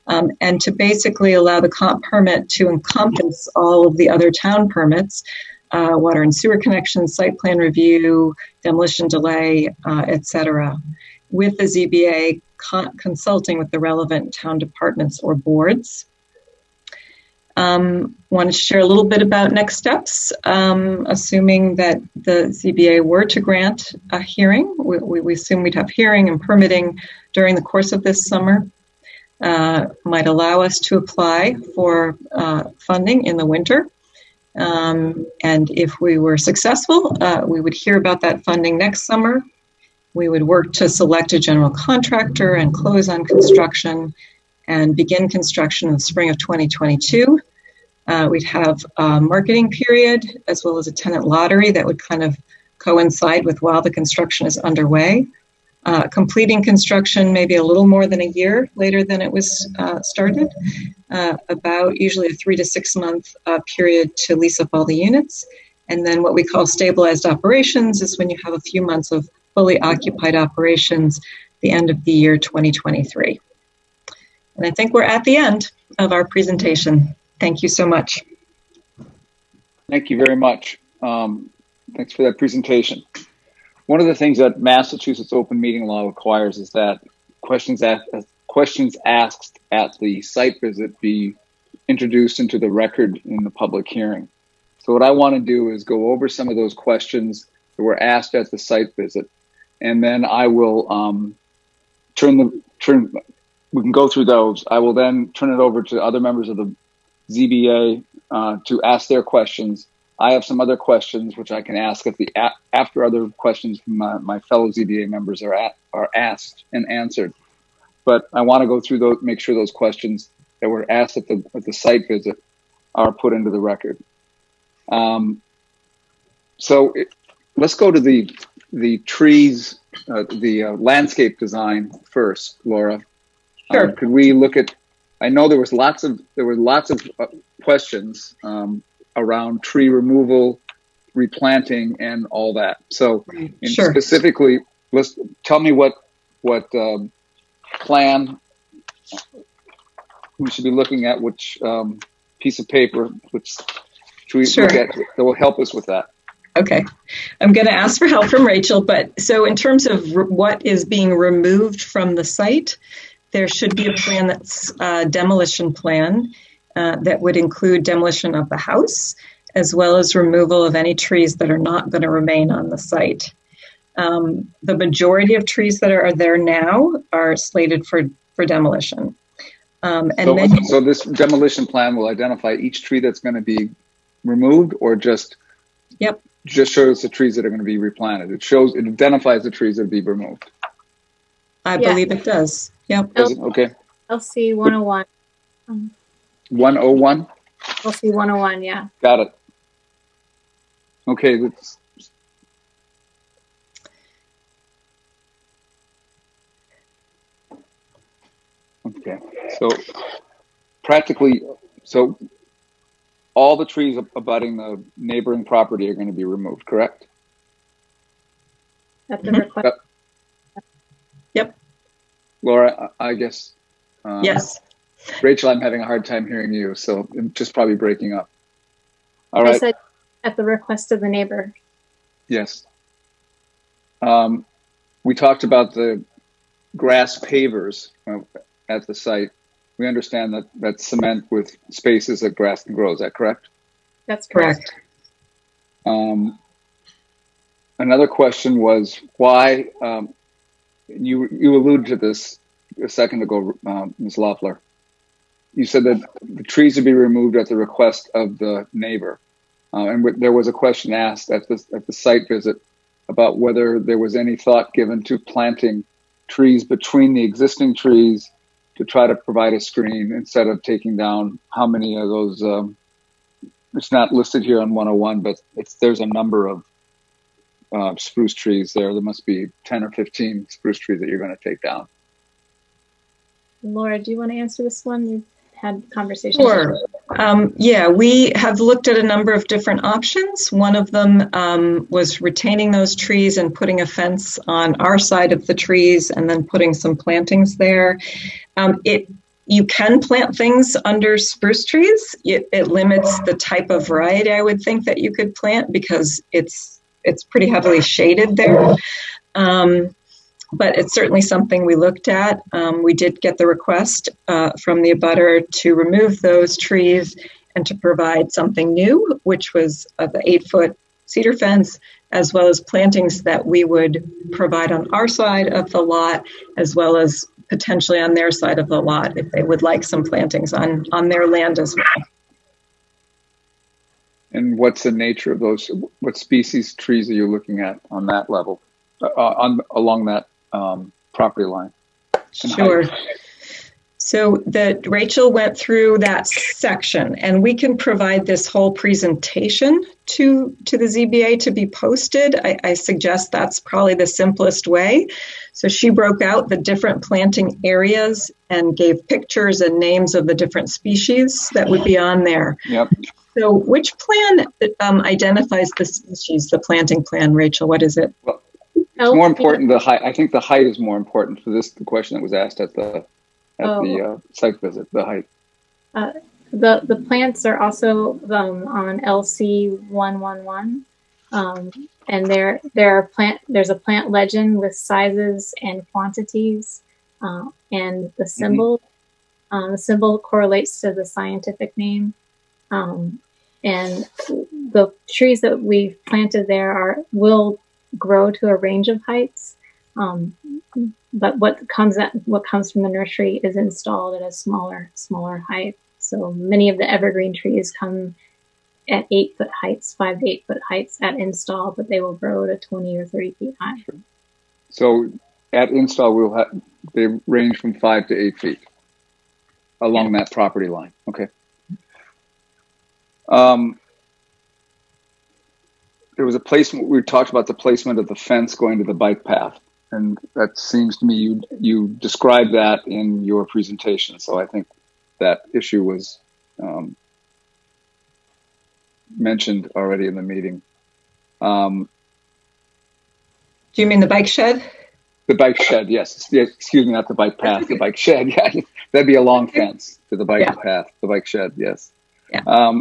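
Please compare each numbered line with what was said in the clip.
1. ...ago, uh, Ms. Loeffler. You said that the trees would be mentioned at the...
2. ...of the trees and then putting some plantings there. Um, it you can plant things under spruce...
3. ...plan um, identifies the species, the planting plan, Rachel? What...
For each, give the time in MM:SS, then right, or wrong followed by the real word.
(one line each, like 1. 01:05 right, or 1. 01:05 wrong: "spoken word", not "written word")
1. 04:13 wrong: "removed", not "mentioned"
2. 04:55 right
3. 06:03 right.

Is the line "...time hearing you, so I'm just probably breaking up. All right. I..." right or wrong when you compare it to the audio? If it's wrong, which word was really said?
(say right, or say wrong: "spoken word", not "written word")
right.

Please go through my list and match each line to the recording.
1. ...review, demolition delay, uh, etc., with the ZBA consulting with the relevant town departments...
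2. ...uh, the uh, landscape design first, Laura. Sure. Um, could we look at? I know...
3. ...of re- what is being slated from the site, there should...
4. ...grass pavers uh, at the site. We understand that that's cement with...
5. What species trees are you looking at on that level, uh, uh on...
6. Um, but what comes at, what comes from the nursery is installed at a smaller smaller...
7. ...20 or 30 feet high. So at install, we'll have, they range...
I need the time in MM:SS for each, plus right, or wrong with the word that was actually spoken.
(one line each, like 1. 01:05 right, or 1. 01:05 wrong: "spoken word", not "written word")
1. 00:07 right
2. 02:10 right
3. 02:39 wrong: "removed", not "slated"
4. 03:56 right
5. 05:36 right
6. 06:39 right
7. 06:52 right.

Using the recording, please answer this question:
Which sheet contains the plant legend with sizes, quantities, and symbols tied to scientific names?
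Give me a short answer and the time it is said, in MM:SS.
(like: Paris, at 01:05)
LC 111, at 06:19.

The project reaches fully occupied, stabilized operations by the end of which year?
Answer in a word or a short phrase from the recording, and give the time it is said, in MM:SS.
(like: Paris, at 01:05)
2023, at 01:12.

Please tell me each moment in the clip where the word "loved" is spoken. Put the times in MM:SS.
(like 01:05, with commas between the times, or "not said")
not said.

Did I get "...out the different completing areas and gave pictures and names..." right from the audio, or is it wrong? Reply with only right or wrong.
wrong.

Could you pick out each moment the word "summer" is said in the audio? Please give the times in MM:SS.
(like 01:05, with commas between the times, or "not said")
00:28, 00:39.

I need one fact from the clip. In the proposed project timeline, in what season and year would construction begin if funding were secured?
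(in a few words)
spring of 2022.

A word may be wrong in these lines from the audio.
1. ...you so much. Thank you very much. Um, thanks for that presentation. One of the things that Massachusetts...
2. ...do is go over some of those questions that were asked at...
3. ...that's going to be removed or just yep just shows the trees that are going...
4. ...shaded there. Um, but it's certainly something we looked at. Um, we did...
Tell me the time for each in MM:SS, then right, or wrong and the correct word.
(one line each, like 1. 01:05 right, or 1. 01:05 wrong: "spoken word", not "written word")
1. 01:17 right
2. 01:35 right
3. 03:03 right
4. 05:07 right.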